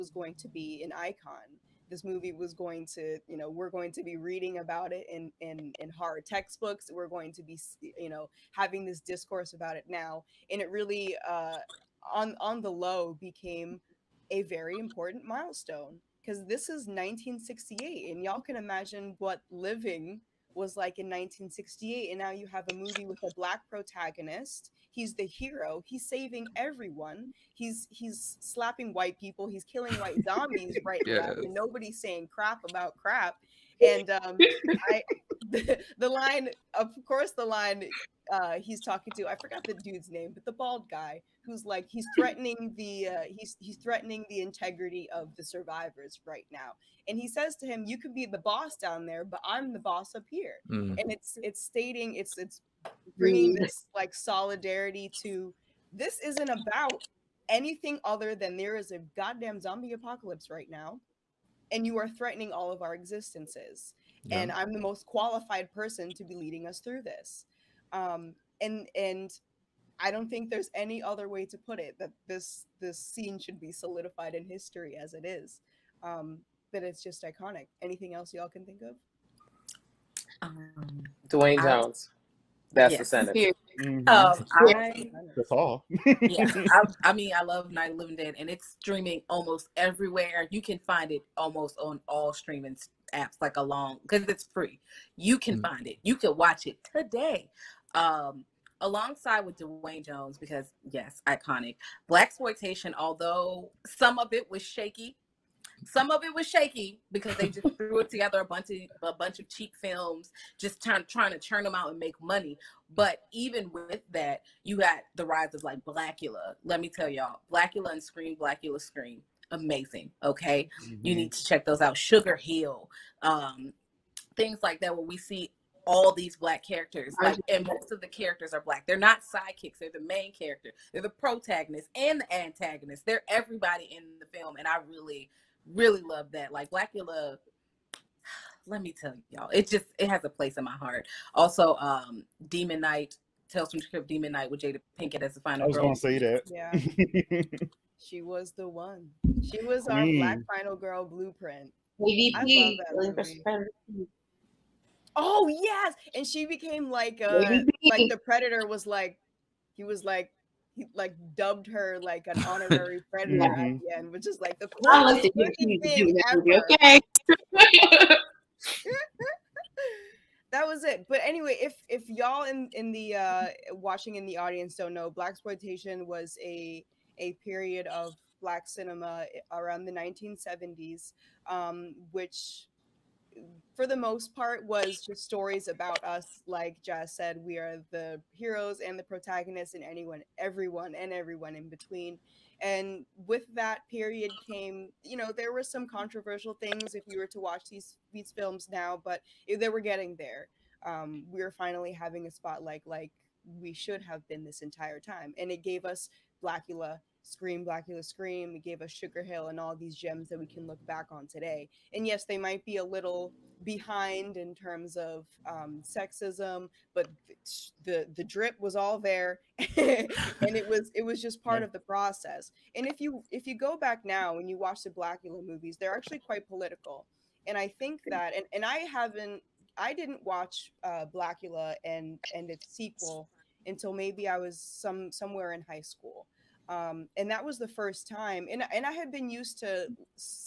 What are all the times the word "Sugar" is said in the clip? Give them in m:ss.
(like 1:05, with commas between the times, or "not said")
2:01, 3:28.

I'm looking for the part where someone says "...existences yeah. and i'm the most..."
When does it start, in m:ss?
1:02.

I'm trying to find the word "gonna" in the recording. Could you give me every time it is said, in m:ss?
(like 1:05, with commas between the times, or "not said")
2:25.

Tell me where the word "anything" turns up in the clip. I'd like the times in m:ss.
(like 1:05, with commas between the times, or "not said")
0:57, 1:17.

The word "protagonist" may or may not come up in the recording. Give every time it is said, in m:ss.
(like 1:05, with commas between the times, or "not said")
0:23, 2:11, 3:09.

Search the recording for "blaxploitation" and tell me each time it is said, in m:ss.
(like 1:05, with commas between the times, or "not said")
1:42, 2:55.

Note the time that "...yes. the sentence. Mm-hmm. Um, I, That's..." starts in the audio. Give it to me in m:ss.
1:22.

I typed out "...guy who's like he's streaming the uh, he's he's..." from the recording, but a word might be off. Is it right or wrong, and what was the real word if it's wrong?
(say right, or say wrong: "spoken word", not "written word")
wrong: "threatening", not "streaming".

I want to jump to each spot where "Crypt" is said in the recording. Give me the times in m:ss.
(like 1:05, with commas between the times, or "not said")
2:23.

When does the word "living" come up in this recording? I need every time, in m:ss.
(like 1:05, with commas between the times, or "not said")
0:19, 1:27.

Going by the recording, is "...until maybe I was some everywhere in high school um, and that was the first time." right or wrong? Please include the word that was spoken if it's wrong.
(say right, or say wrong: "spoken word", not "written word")
wrong: "somewhere", not "everywhere".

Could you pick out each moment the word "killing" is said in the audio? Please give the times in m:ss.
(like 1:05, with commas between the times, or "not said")
0:29.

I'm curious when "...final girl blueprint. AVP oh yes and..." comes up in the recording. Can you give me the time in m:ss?
2:30.